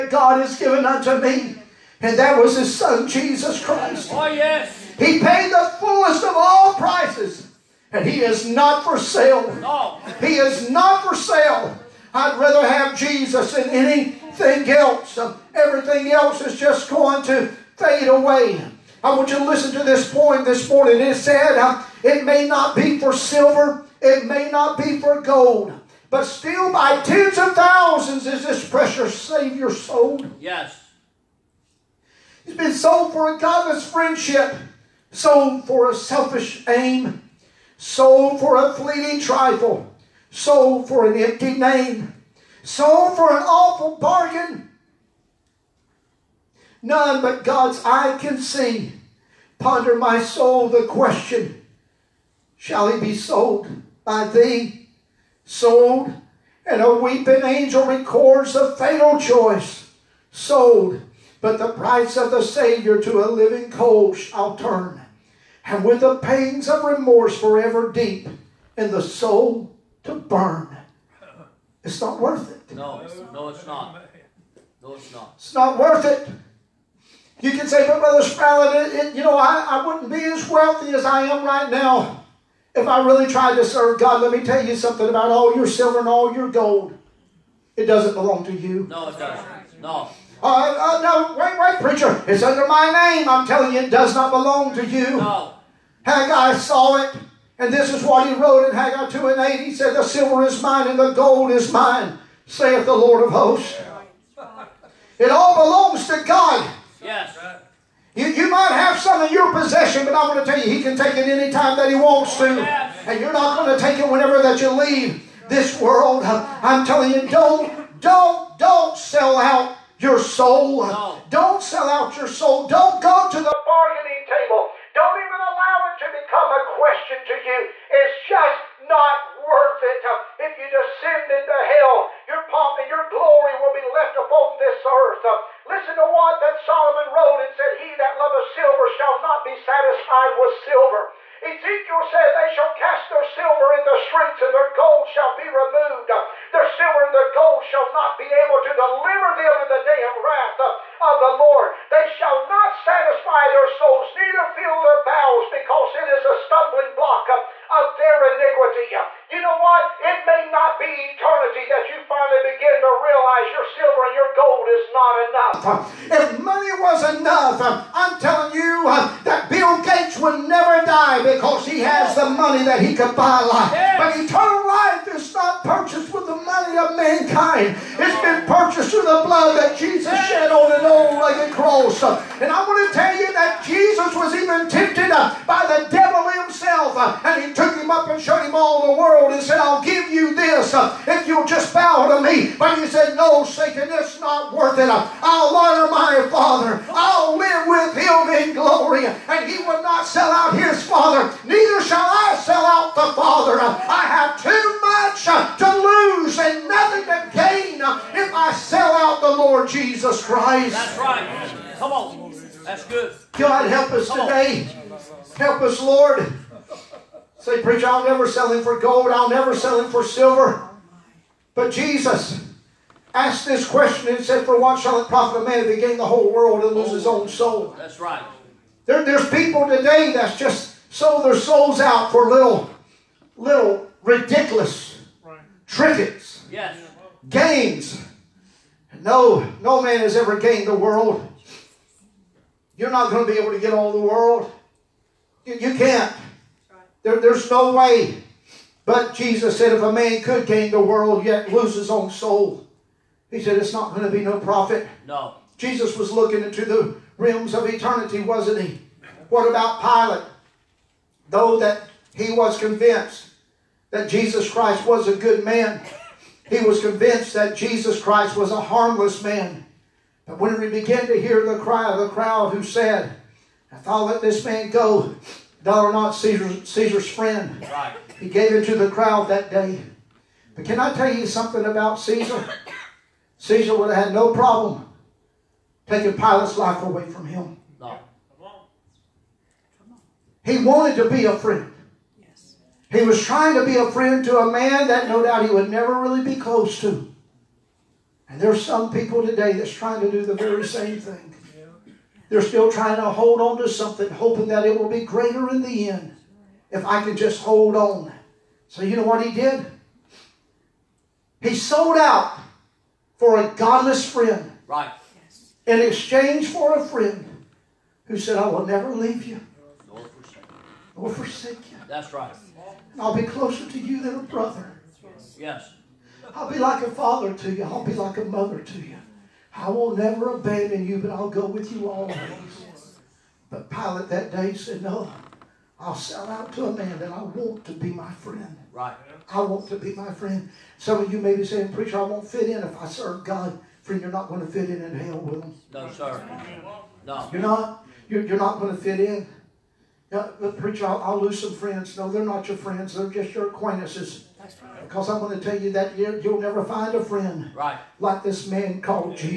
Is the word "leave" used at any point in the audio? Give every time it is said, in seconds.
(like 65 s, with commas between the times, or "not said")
114 s, 318 s.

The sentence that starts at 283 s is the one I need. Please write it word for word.
Caesar would have had no problem taking Pilate's life away from him.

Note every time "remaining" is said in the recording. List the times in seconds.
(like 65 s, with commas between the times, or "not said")
not said.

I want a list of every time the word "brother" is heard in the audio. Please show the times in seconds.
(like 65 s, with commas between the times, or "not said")
77 s, 324 s.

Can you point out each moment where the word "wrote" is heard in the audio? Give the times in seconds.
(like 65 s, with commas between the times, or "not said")
98 s, 137 s.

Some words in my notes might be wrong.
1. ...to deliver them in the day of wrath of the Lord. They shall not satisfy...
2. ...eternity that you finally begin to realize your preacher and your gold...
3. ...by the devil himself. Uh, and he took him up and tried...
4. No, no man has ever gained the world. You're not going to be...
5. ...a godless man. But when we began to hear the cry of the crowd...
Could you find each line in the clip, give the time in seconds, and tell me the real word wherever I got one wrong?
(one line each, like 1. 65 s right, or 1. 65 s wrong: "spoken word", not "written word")
1. 148 s right
2. 161 s wrong: "silver", not "preacher"
3. 185 s wrong: "showed", not "tried"
4. 239 s right
5. 268 s wrong: "harmless", not "godless".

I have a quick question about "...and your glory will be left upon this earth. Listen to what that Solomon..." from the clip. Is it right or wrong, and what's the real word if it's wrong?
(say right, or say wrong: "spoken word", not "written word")
right.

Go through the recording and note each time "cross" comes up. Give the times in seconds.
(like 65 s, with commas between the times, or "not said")
181 s.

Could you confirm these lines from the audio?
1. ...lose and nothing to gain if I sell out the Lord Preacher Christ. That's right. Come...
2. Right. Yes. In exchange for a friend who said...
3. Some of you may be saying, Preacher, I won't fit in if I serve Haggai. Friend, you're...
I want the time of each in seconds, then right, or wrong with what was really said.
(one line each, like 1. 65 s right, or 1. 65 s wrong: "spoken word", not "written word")
1. 205 s wrong: "Jesus", not "Preacher"
2. 314 s right
3. 340 s wrong: "God", not "Haggai".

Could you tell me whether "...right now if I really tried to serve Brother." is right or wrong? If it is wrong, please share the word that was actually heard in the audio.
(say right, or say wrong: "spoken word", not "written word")
wrong: "God", not "Brother".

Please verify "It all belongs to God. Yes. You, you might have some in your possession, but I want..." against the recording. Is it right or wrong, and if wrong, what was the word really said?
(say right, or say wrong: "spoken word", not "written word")
right.